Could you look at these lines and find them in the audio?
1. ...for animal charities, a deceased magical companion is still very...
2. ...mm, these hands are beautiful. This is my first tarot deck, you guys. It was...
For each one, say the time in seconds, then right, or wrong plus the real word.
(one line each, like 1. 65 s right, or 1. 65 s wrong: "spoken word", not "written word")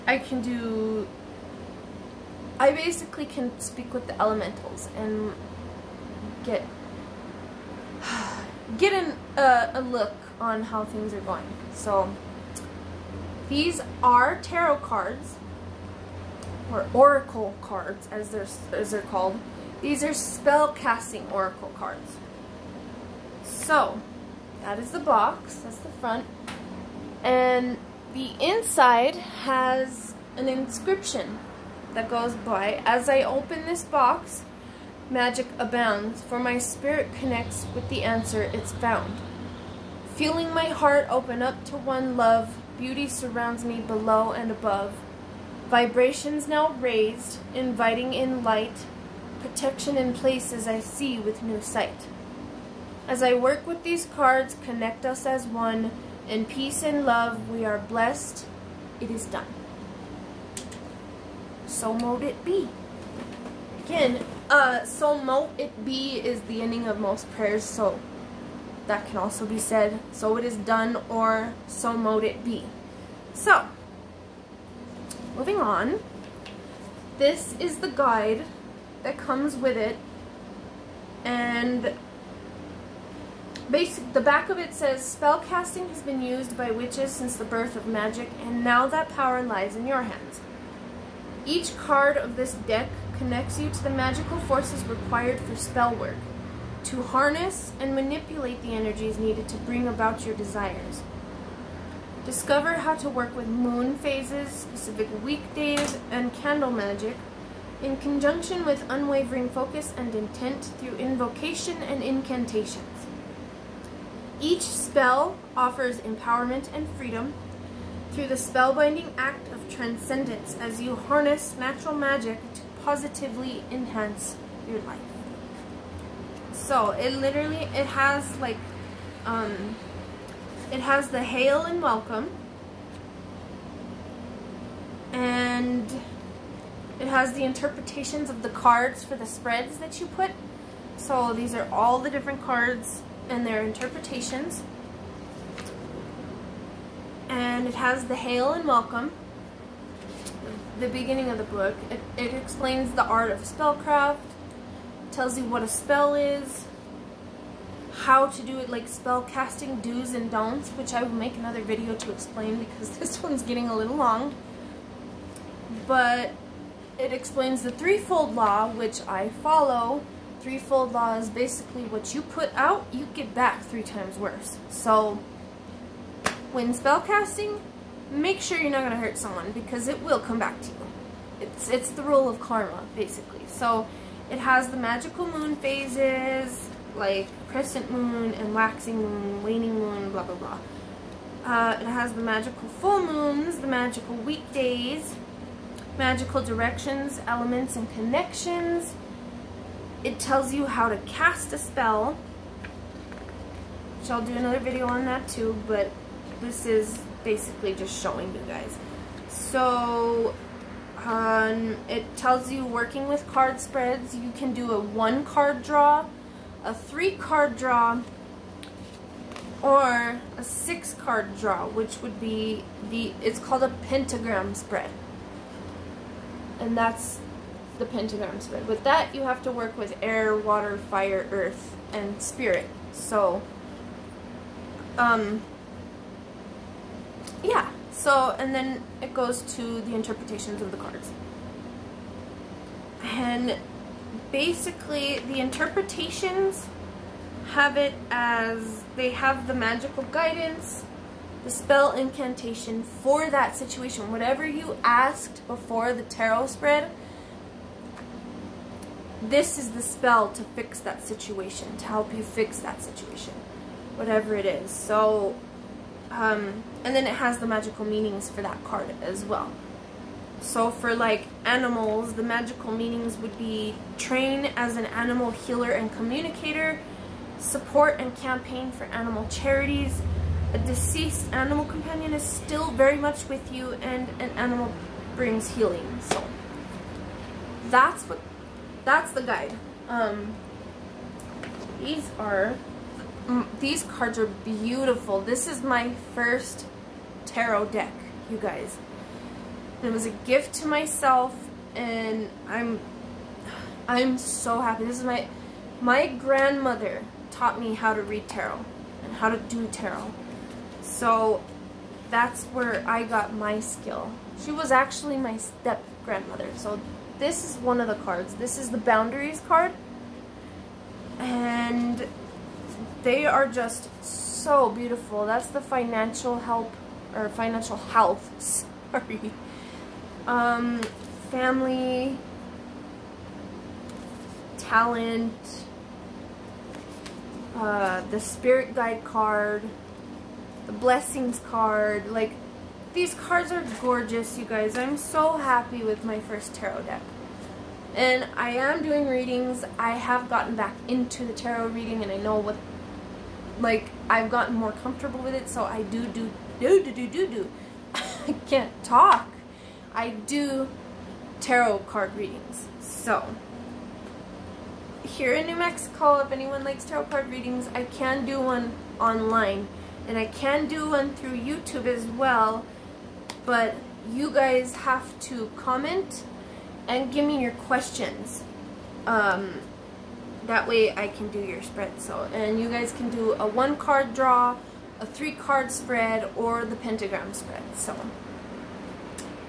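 1. 278 s wrong: "animal", not "magical"
2. 293 s wrong: "cards", not "hands".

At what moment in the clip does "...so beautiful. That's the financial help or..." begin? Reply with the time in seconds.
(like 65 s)
324 s.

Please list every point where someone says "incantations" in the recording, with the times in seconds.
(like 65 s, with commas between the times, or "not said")
112 s, 251 s.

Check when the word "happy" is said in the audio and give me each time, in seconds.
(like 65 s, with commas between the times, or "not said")
304 s, 345 s.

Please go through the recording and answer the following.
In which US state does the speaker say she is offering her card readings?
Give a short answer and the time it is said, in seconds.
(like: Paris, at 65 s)
New Mexico, at 365 s.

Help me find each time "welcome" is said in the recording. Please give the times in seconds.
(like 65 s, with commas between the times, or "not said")
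131 s, 148 s.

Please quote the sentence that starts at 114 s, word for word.
Each spell offers empowerment and freedom through the spellbinding act of transcendence as you harness natural magic to positively enhance your life.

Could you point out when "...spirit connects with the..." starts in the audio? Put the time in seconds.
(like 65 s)
36 s.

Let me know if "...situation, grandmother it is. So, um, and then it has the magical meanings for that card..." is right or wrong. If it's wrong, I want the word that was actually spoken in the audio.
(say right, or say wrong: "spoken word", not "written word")
wrong: "whatever", not "grandmother".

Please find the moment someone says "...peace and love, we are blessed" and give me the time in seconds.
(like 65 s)
56 s.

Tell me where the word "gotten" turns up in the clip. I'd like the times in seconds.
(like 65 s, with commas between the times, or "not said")
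350 s, 354 s.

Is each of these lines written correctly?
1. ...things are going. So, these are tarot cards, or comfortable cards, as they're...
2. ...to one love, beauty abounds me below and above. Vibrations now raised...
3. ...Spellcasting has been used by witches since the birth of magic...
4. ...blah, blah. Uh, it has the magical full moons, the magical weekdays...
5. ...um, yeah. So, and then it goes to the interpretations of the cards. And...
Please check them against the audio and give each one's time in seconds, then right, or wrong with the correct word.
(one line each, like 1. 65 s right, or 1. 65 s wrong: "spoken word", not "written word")
1. 10 s wrong: "oracle", not "comfortable"
2. 41 s wrong: "surrounds", not "abounds"
3. 85 s right
4. 190 s right
5. 234 s right.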